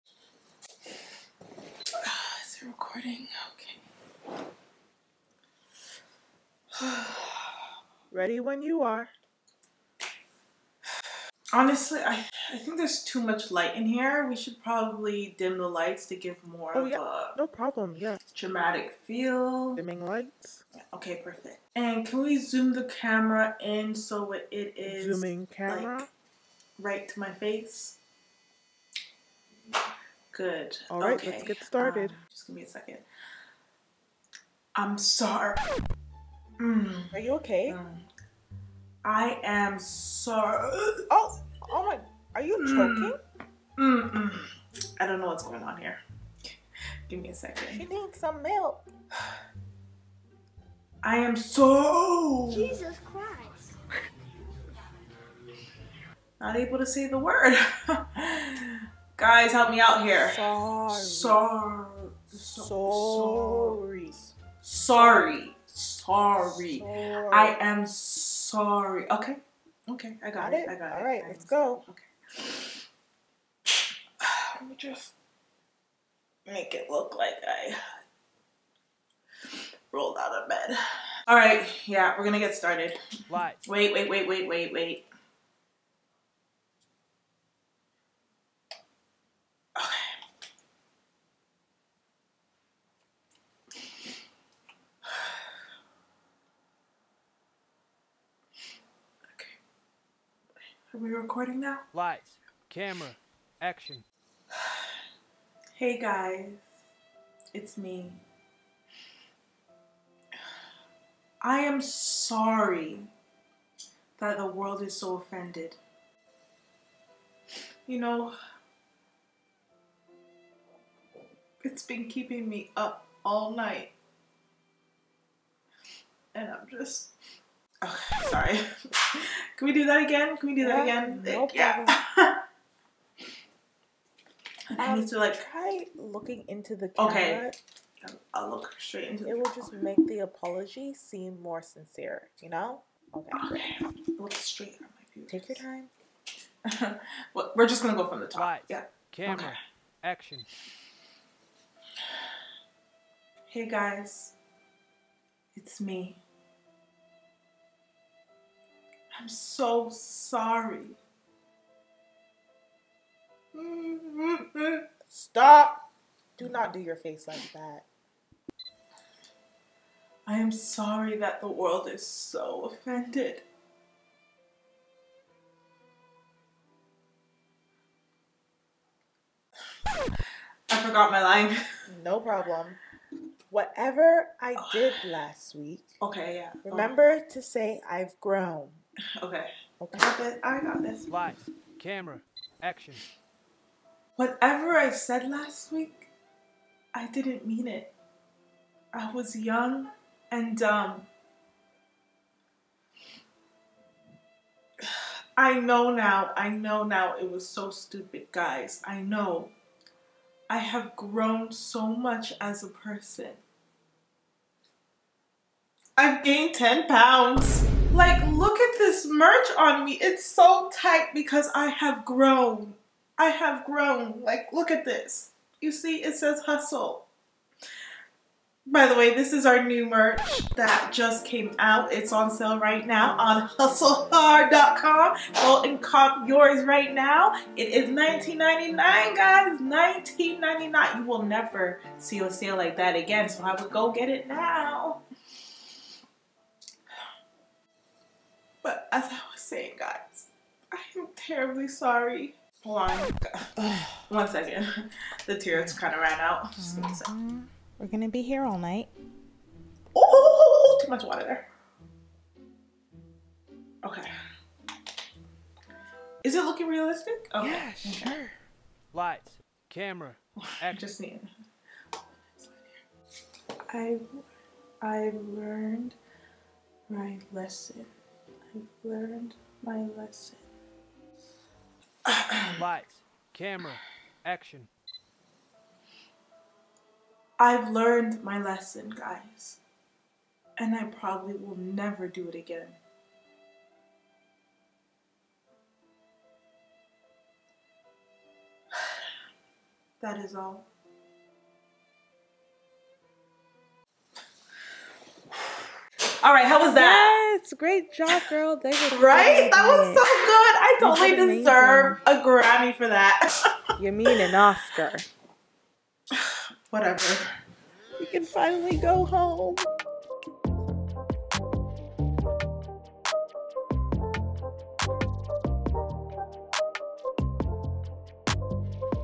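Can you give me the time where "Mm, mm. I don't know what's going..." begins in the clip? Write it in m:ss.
0:43.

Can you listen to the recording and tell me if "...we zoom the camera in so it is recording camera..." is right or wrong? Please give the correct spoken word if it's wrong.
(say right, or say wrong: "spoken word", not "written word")
wrong: "zooming", not "recording".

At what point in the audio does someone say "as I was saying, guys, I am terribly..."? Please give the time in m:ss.
4:08.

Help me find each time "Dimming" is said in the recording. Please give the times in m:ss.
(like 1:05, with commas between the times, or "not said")
0:19.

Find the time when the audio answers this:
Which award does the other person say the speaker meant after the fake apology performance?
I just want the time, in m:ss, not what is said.
5:14.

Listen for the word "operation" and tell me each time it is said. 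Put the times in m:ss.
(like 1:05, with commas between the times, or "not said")
not said.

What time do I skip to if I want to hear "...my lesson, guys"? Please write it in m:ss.
4:48.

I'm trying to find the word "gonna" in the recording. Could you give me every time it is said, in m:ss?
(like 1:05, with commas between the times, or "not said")
1:22, 2:27.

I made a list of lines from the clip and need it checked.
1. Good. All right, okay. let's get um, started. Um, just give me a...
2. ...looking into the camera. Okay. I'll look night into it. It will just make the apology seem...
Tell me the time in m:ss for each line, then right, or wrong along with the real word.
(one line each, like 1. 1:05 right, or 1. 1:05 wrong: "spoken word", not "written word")
1. 0:30 right
2. 2:15 wrong: "straight", not "night".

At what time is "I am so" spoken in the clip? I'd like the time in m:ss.
0:51.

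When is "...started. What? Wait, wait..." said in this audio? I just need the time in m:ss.
1:22.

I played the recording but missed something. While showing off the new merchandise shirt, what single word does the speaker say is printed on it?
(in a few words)
Hustle.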